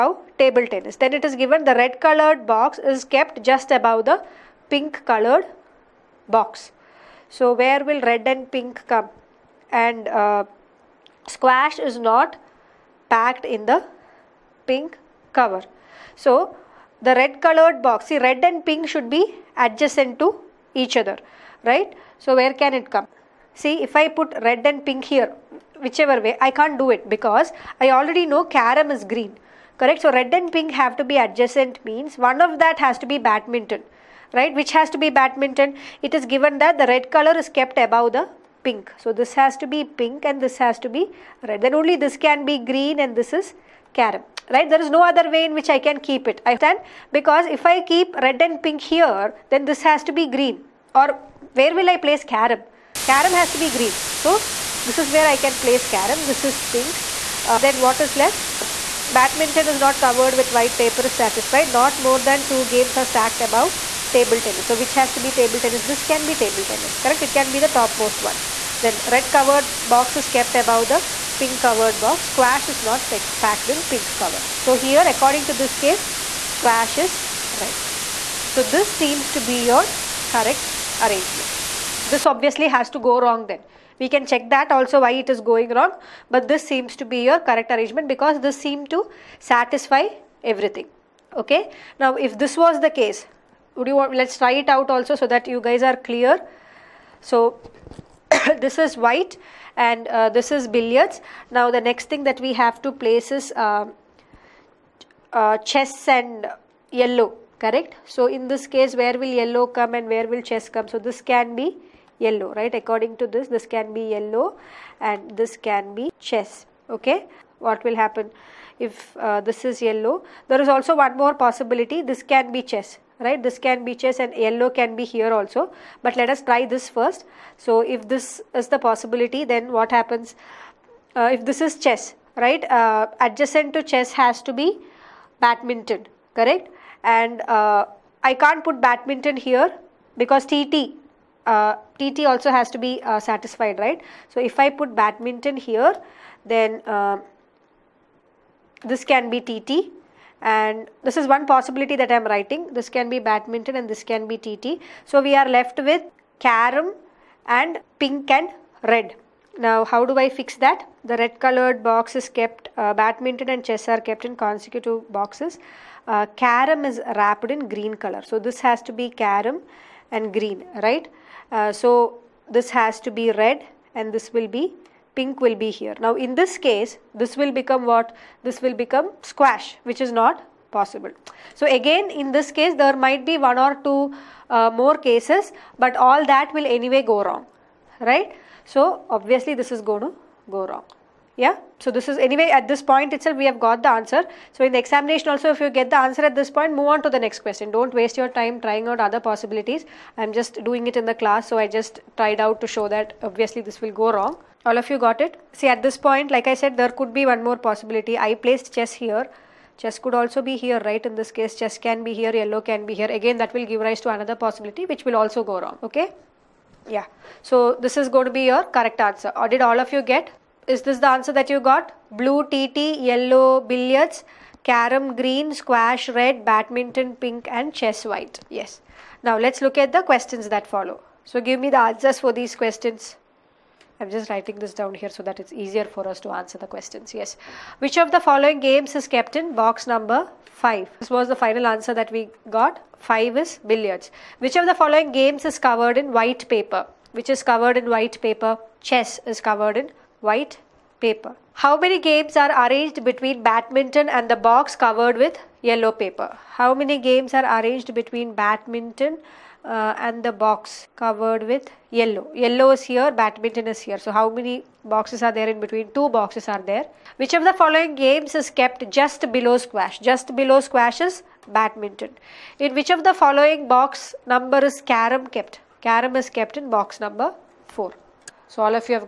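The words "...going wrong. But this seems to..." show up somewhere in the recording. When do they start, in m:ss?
1:25.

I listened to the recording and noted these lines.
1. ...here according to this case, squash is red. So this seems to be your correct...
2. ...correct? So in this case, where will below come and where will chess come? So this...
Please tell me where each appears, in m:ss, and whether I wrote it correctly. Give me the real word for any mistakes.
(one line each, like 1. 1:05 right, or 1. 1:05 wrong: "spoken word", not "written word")
1. 1:14 right
2. 1:47 wrong: "yellow", not "below".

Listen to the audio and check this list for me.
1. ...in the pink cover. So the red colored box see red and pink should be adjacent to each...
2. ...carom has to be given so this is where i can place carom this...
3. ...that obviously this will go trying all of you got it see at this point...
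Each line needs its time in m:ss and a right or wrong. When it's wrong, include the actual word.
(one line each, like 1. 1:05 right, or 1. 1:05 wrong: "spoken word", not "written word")
1. 0:13 right
2. 0:53 wrong: "green", not "given"
3. 3:22 wrong: "wrong", not "trying".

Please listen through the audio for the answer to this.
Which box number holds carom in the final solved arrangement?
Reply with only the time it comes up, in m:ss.
4:35.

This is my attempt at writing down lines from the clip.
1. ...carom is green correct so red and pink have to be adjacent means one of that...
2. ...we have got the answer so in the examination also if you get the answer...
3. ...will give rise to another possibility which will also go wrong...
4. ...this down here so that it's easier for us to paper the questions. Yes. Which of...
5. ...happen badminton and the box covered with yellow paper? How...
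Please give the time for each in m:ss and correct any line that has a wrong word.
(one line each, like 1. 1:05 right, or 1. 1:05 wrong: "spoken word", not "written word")
1. 0:28 right
2. 3:13 right
3. 3:33 right
4. 3:54 wrong: "answer", not "paper"
5. 4:13 wrong: "between", not "happen".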